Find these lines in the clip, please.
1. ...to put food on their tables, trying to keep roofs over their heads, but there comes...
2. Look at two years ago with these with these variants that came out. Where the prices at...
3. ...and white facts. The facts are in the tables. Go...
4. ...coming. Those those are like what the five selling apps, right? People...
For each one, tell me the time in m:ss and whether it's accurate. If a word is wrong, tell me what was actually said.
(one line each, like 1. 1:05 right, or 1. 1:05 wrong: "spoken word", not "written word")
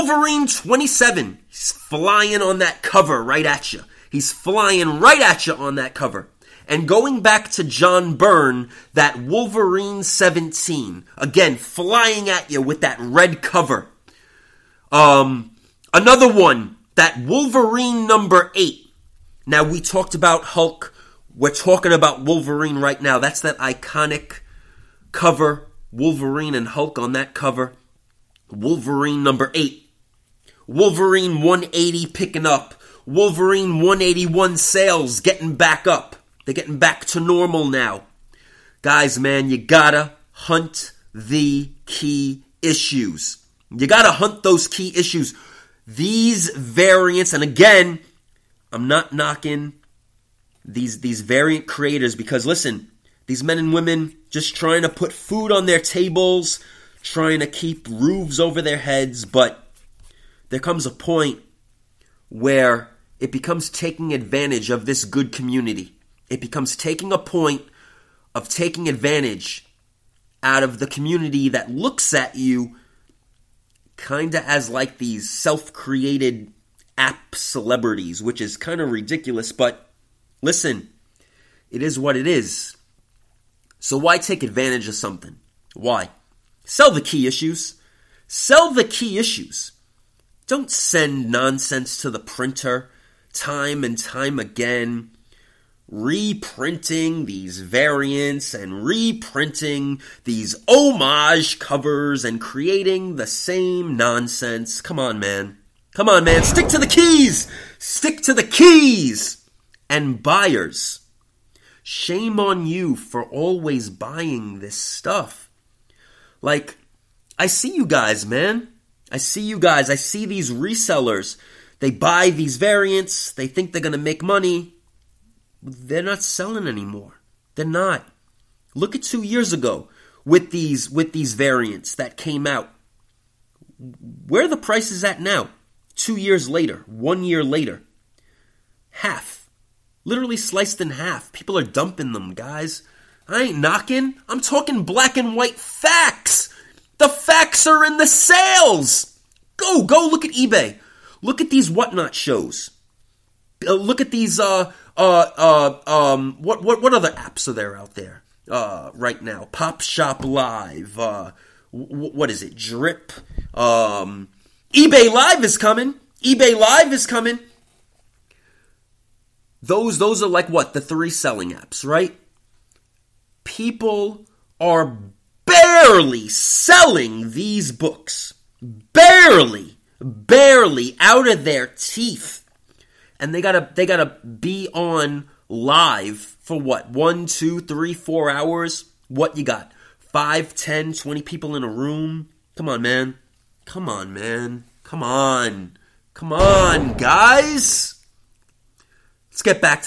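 1. 0:54 right
2. 2:08 right
3. 2:25 wrong: "sales", not "tables"
4. 2:47 wrong: "three", not "five".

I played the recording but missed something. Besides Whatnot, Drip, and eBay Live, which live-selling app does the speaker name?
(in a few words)
Pop Shop Live.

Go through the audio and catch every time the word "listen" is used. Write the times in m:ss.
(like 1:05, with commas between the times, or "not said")
0:52, 1:20.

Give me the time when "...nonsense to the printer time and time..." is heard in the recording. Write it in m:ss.
1:31.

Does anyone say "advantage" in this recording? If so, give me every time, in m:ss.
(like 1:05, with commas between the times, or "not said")
1:04, 1:08, 1:24.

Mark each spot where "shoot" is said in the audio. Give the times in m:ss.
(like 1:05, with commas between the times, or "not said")
not said.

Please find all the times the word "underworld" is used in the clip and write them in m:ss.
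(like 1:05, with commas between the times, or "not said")
not said.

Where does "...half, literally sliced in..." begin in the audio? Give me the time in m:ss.
2:18.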